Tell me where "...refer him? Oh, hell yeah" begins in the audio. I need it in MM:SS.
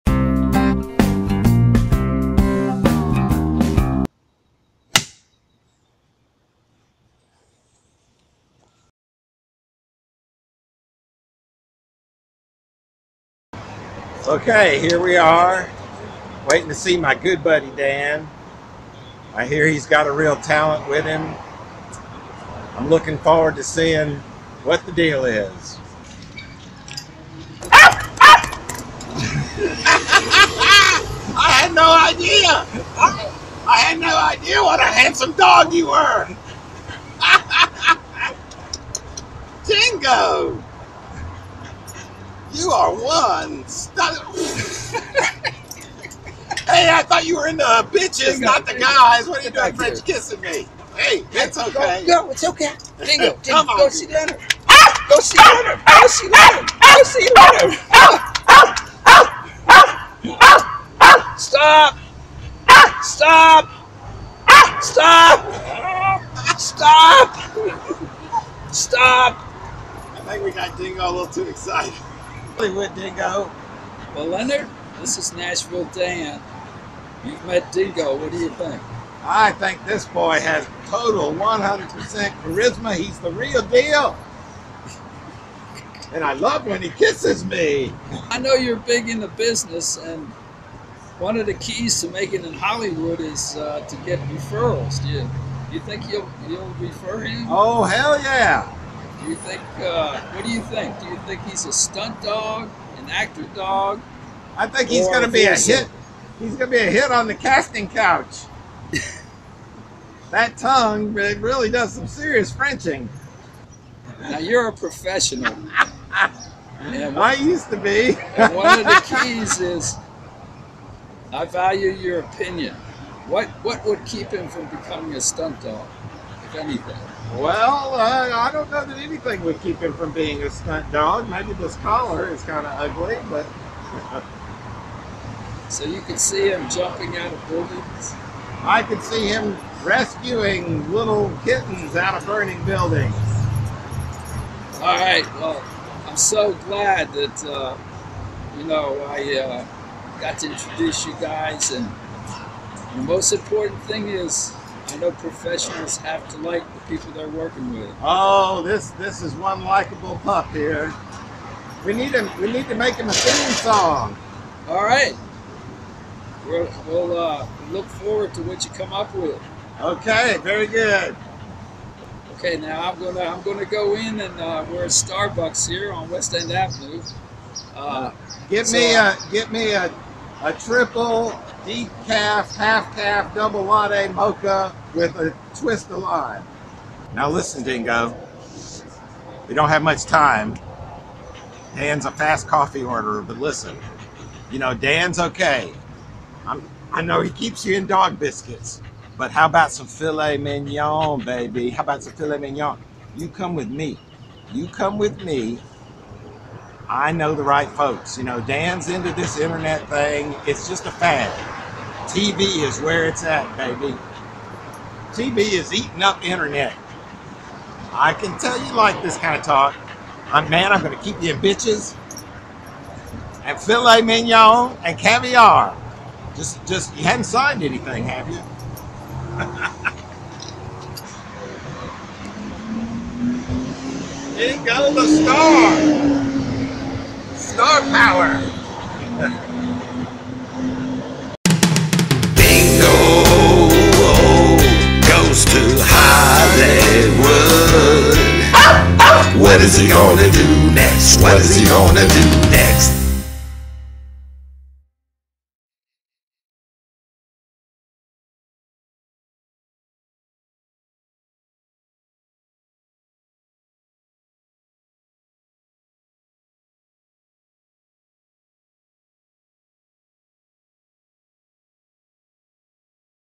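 01:36.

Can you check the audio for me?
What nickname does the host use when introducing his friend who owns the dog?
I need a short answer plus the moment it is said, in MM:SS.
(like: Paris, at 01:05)
Nashville Dan, at 01:15.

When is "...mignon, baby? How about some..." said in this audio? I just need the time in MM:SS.
03:20.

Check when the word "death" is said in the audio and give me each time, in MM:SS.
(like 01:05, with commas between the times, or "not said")
not said.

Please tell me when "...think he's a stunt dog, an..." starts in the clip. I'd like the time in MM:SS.
01:41.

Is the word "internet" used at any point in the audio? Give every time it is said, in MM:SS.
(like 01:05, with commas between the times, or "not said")
03:29, 03:36.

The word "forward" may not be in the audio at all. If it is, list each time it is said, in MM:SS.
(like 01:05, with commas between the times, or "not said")
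00:23, 02:47.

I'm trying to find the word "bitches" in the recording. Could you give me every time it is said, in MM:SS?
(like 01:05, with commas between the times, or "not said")
00:47, 03:41.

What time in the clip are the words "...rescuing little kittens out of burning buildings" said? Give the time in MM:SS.
02:19.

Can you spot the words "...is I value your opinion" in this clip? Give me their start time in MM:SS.
01:59.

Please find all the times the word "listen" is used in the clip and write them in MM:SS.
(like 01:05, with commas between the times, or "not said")
03:07, 03:13.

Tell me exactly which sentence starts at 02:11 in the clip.
Maybe this collar is kind of ugly, but.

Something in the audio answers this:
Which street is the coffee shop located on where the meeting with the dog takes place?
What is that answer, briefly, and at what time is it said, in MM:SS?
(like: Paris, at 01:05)
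West End Avenue, at 02:56.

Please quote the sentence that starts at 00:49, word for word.
What are you doing, French kissing me?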